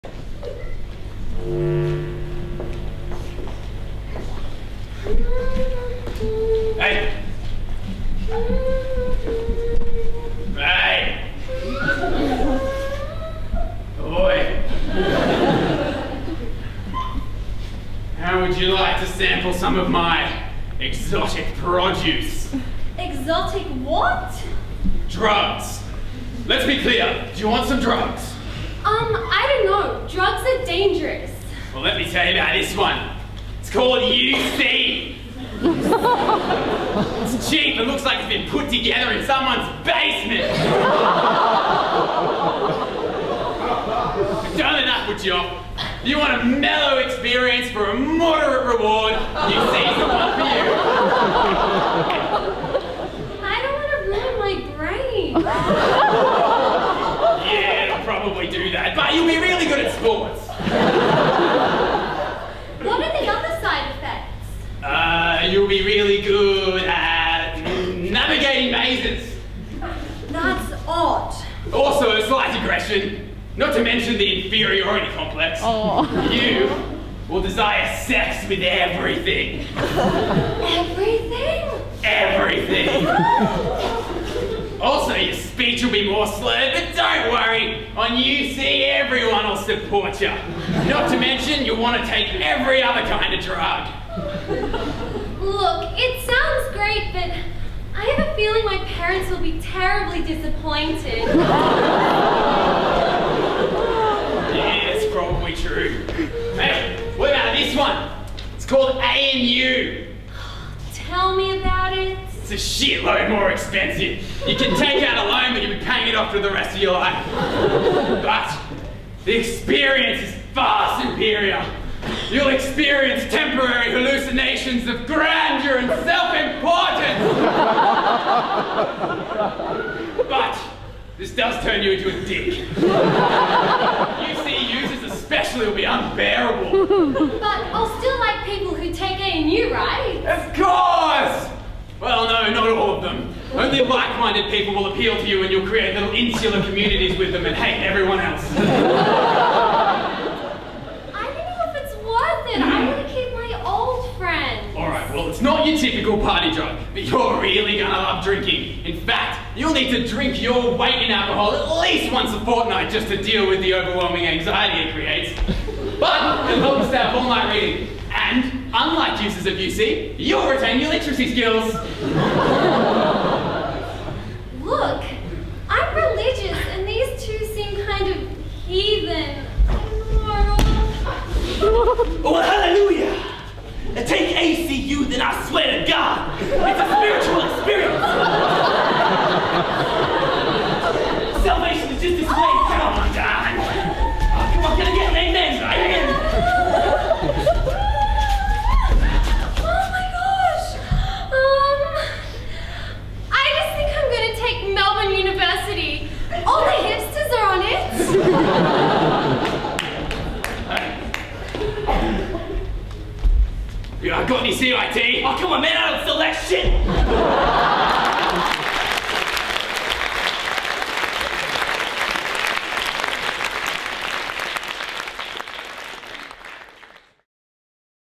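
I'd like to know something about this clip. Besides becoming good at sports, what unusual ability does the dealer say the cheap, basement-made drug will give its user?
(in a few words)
Navigating mazes.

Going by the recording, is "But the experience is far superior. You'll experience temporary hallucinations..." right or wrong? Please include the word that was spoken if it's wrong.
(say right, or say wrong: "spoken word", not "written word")
right.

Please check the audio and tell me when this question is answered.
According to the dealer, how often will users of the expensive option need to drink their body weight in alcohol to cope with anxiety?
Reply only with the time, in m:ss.
2:42.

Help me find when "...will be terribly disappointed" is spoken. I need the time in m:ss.
1:39.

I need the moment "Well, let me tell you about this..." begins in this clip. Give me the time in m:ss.
0:31.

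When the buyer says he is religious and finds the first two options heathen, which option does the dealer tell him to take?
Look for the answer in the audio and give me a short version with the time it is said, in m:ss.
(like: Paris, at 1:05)
ACU, at 3:04.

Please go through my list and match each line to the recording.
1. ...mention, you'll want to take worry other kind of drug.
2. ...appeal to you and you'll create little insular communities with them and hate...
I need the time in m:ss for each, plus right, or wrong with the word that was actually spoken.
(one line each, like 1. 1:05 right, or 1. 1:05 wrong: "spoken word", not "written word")
1. 1:31 wrong: "every", not "worry"
2. 2:24 right.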